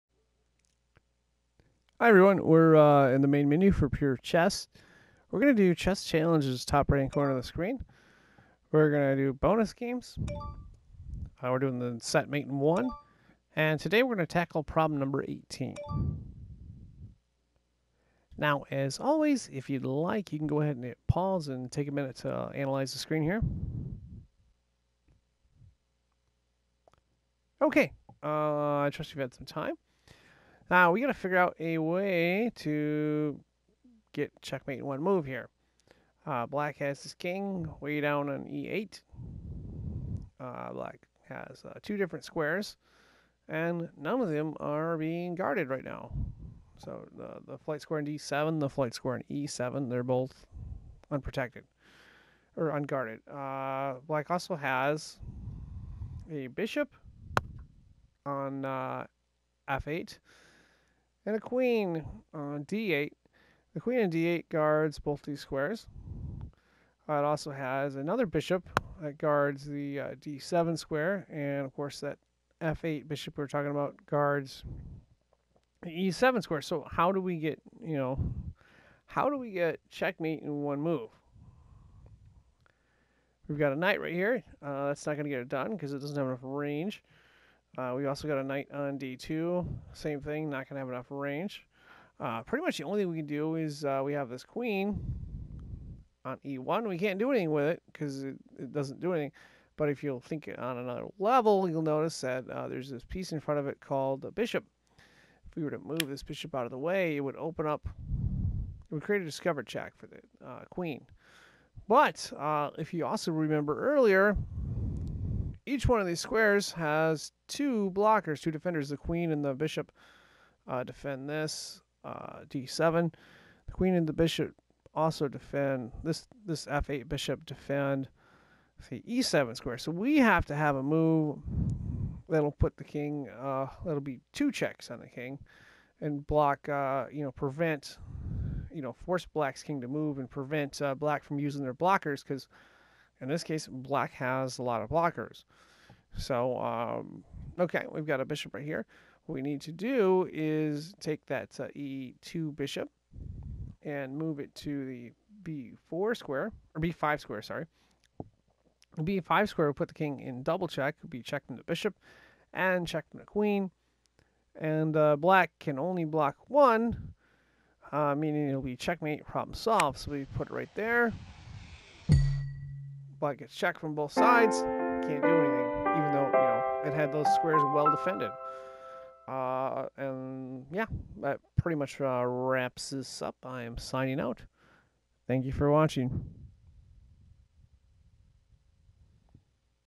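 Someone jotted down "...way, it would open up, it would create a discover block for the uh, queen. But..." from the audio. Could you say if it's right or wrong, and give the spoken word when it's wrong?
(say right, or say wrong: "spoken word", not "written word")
wrong: "check", not "block".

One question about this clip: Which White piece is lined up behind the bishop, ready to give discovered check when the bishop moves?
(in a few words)
queen on e1.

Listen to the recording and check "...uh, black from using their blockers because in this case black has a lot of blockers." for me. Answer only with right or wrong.
right.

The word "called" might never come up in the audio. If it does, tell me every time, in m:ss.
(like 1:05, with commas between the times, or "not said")
1:43.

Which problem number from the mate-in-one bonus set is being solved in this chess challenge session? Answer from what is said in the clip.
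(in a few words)
18.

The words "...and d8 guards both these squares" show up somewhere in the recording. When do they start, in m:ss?
1:03.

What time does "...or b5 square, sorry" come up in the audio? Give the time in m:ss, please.
2:36.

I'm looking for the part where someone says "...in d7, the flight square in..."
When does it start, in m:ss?
0:47.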